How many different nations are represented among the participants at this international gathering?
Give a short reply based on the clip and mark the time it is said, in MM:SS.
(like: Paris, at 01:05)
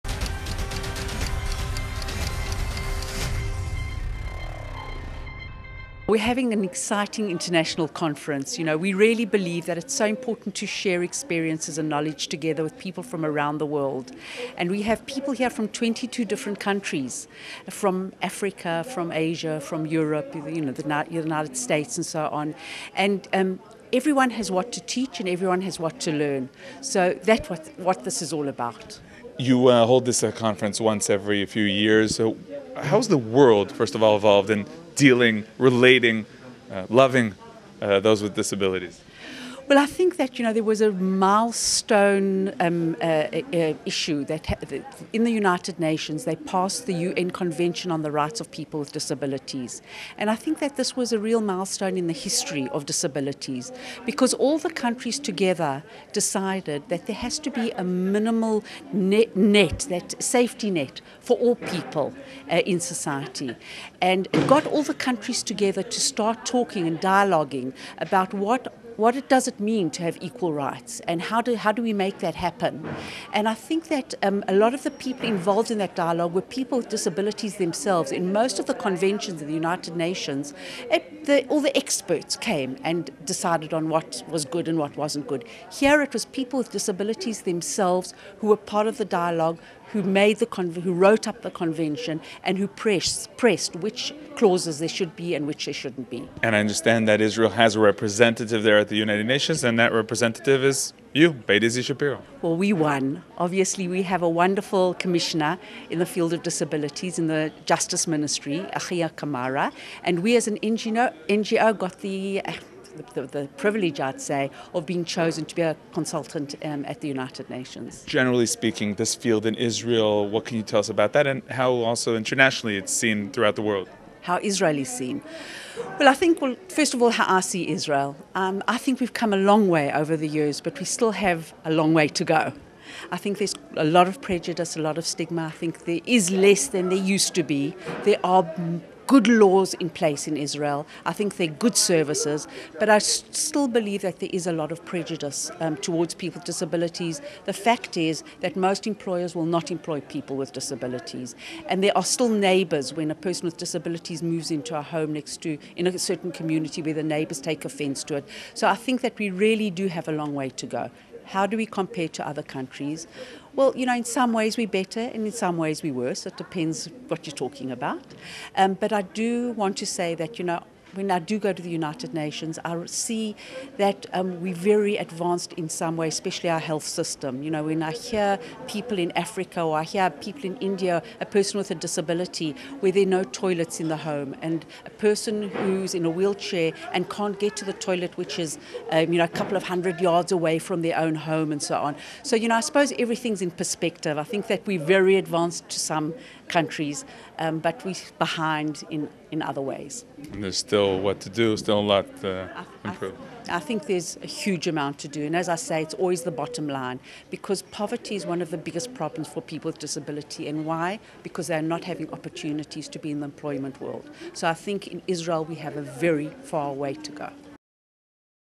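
22, at 00:15.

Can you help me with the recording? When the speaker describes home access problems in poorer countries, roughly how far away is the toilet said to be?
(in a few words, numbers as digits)
A couple of hundred yards.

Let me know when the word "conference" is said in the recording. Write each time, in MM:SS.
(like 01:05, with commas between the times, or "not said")
00:07, 00:30.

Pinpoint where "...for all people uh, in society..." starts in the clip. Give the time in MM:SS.
01:01.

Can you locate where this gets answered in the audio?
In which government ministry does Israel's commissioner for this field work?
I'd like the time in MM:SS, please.
01:47.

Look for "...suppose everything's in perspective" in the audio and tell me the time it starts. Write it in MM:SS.
03:12.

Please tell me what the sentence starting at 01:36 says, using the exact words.
And I understand that Israel has a representative there at the United Nations, and that representative is you, Beta Shapiro.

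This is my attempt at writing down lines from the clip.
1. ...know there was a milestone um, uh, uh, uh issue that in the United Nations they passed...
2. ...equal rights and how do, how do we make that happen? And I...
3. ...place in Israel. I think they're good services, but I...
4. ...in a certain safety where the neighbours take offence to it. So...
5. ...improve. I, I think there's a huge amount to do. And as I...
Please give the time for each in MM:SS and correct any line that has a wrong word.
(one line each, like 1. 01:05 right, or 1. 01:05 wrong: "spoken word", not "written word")
1. 00:40 right
2. 01:10 right
3. 02:19 right
4. 02:35 wrong: "community", not "safety"
5. 03:22 right.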